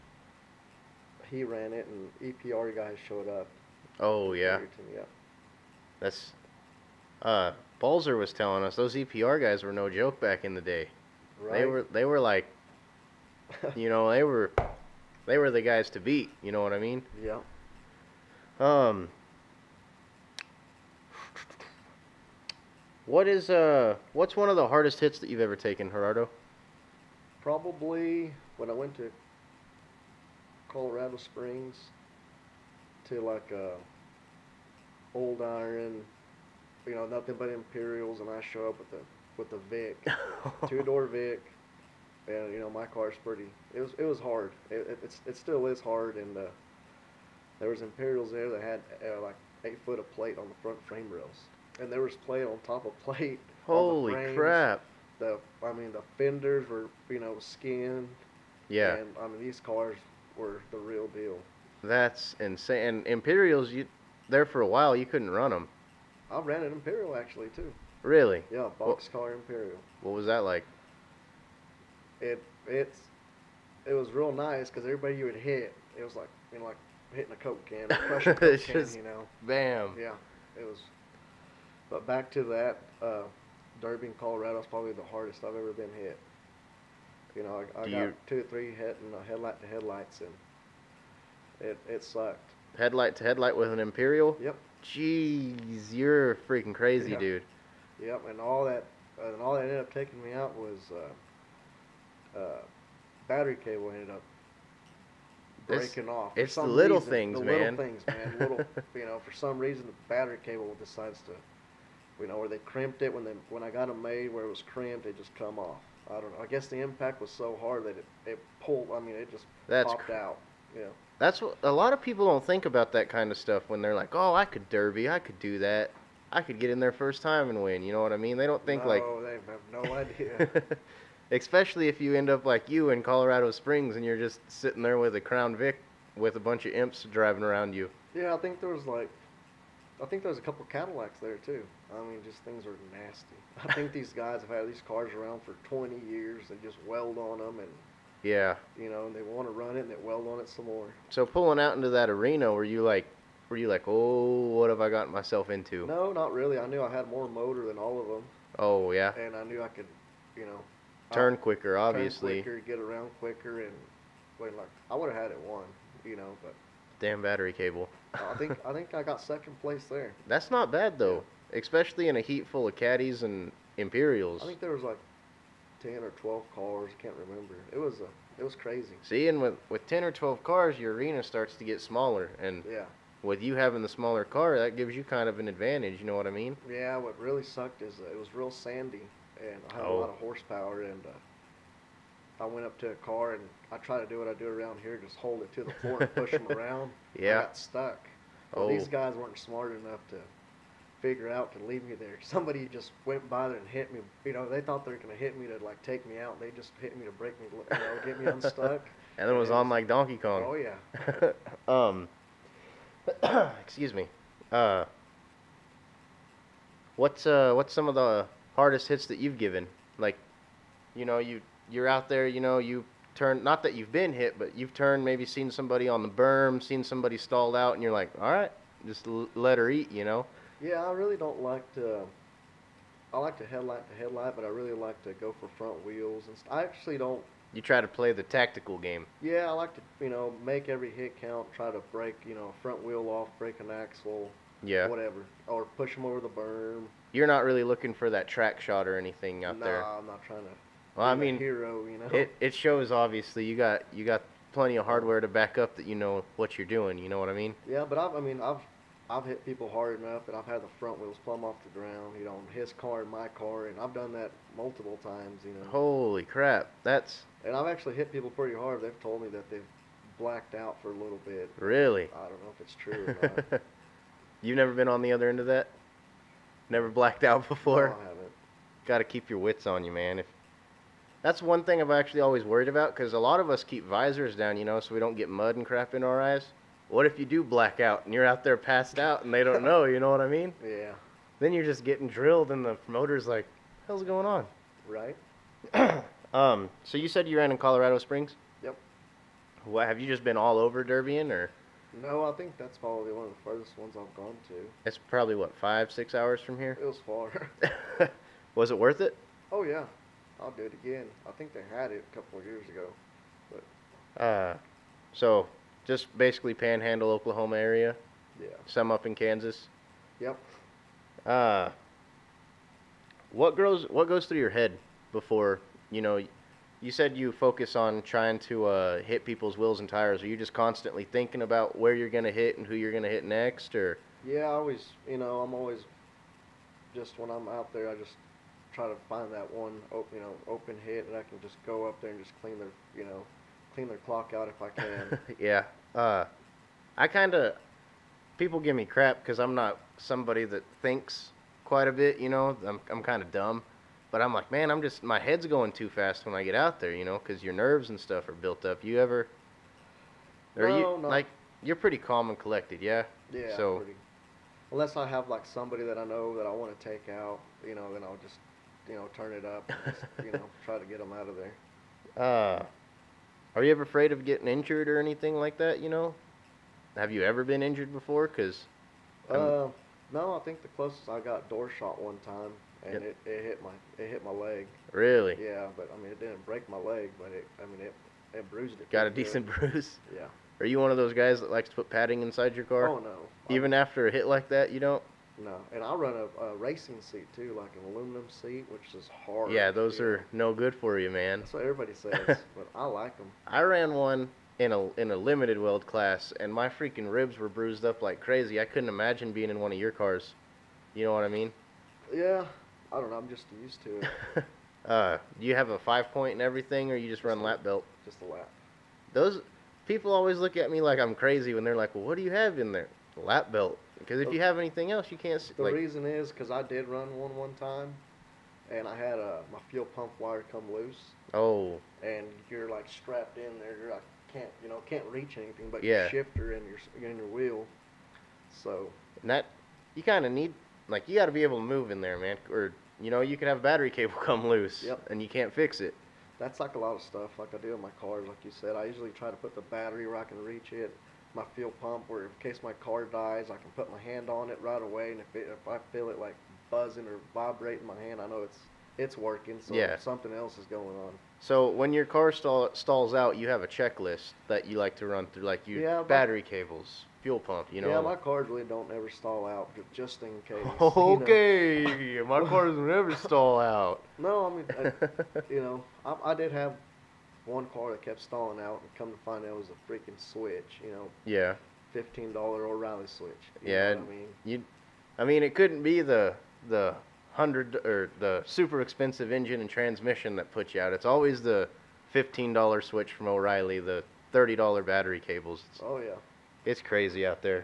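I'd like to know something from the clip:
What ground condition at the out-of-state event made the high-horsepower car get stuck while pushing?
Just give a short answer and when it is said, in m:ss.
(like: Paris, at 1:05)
Sandy, at 3:08.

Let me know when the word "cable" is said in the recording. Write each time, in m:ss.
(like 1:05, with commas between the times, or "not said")
1:43, 1:50, 2:47, 7:23, 7:46, 8:15.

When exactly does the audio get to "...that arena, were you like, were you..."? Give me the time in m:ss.
2:31.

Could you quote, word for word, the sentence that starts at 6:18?
Cause, uh, no, I think the closest I got door shot one time, and yep.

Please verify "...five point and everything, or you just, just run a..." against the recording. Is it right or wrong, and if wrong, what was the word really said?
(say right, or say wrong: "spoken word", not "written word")
right.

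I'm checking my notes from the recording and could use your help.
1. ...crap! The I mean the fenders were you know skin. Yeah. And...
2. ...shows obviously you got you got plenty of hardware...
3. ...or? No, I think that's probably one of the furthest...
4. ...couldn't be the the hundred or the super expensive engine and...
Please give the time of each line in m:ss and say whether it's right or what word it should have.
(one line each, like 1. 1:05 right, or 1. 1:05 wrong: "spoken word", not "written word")
1. 0:54 right
2. 4:12 right
3. 5:01 right
4. 8:05 right.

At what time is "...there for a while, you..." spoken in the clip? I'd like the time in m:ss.
1:04.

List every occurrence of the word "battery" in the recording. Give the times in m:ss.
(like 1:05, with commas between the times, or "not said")
1:43, 1:50, 2:47, 7:23, 7:29, 7:46, 8:14.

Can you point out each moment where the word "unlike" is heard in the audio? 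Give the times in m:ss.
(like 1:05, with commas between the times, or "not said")
not said.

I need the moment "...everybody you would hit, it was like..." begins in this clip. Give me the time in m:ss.
1:14.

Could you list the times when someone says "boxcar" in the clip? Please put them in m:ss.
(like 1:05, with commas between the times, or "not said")
1:08.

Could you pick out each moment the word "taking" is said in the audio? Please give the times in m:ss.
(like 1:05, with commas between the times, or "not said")
1:39.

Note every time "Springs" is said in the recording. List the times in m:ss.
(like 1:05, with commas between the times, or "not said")
0:31, 2:13, 4:57.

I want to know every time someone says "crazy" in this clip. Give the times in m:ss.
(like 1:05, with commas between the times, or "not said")
1:36, 2:58, 6:48, 7:01, 8:16.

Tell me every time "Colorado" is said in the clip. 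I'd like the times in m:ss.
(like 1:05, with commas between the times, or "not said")
0:30, 1:24, 2:13, 4:57.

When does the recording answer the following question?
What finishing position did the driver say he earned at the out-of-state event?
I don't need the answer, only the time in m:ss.
2:49.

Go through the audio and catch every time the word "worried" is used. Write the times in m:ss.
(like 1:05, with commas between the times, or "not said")
4:42.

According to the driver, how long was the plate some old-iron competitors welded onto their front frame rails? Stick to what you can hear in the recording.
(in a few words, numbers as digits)
8 foot.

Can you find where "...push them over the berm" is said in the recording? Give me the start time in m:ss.
4:05.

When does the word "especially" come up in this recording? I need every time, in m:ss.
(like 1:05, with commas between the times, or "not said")
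2:11, 2:51.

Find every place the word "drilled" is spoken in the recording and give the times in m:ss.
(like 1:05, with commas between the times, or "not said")
4:52.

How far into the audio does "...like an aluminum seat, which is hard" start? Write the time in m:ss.
6:37.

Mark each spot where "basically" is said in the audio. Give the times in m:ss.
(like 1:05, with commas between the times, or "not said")
5:16.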